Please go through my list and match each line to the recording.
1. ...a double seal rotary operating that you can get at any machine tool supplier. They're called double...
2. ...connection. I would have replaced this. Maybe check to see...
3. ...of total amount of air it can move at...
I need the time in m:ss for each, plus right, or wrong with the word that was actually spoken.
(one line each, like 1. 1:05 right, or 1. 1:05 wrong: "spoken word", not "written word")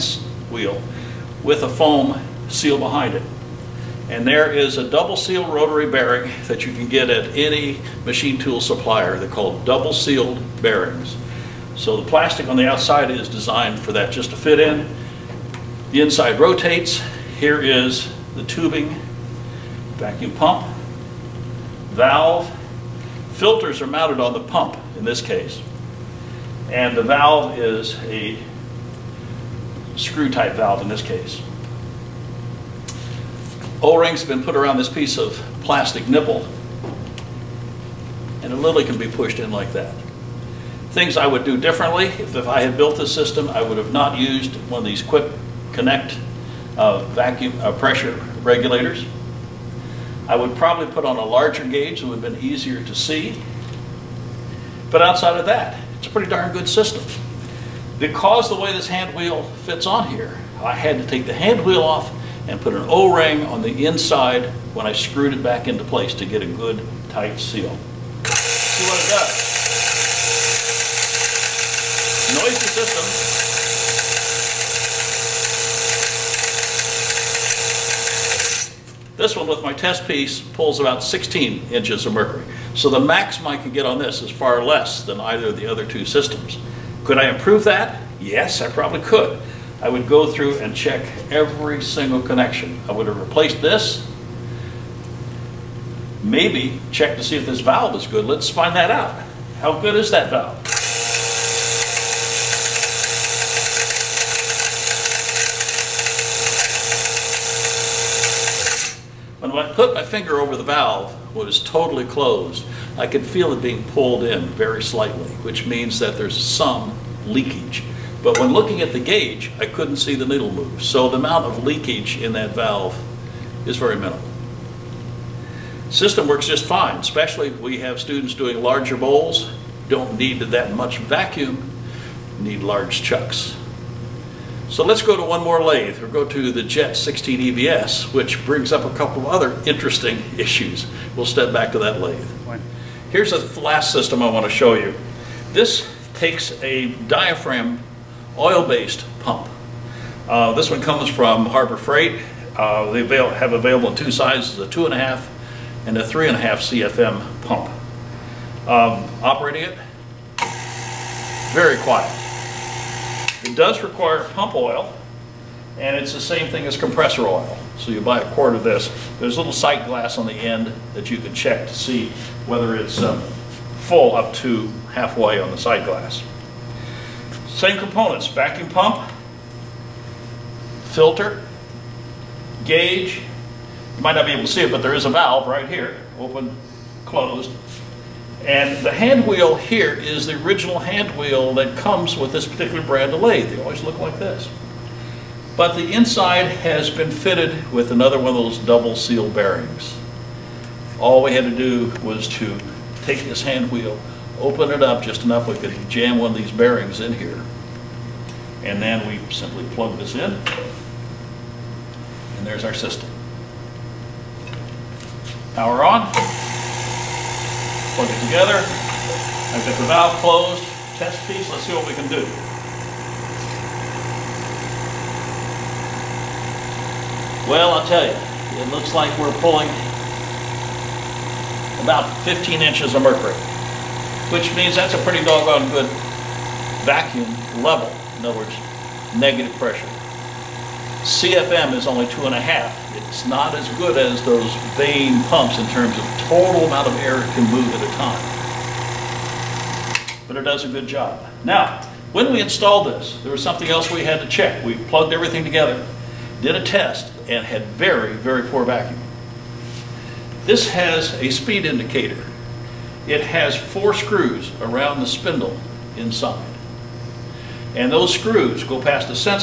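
1. 0:04 wrong: "bearing", not "operating"
2. 1:32 right
3. 4:05 right.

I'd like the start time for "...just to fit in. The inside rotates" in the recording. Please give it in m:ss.
0:14.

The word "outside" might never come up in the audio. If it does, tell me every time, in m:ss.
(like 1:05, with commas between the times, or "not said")
0:12, 0:55.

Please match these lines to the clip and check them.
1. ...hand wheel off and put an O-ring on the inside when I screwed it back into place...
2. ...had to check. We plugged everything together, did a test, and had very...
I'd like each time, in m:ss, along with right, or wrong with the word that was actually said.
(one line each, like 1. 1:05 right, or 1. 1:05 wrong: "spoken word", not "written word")
1. 1:01 right
2. 4:14 right.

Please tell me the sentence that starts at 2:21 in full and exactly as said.
We'll step back to that lathe.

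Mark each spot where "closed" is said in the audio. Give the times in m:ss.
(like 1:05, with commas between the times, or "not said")
1:52, 3:07, 3:40.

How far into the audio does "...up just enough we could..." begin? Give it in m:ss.
3:24.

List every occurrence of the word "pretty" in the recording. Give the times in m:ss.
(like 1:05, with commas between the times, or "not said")
0:56, 3:54.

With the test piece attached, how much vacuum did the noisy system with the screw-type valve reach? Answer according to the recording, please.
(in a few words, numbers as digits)
16 inches of mercury.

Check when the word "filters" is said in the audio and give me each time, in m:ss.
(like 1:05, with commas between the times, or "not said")
0:23, 3:00.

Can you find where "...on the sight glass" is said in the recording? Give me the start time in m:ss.
2:55.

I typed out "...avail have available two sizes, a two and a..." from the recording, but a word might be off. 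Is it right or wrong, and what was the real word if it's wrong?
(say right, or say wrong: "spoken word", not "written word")
right.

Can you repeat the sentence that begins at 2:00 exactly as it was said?
So the amount of leakage in that valve is very minimal.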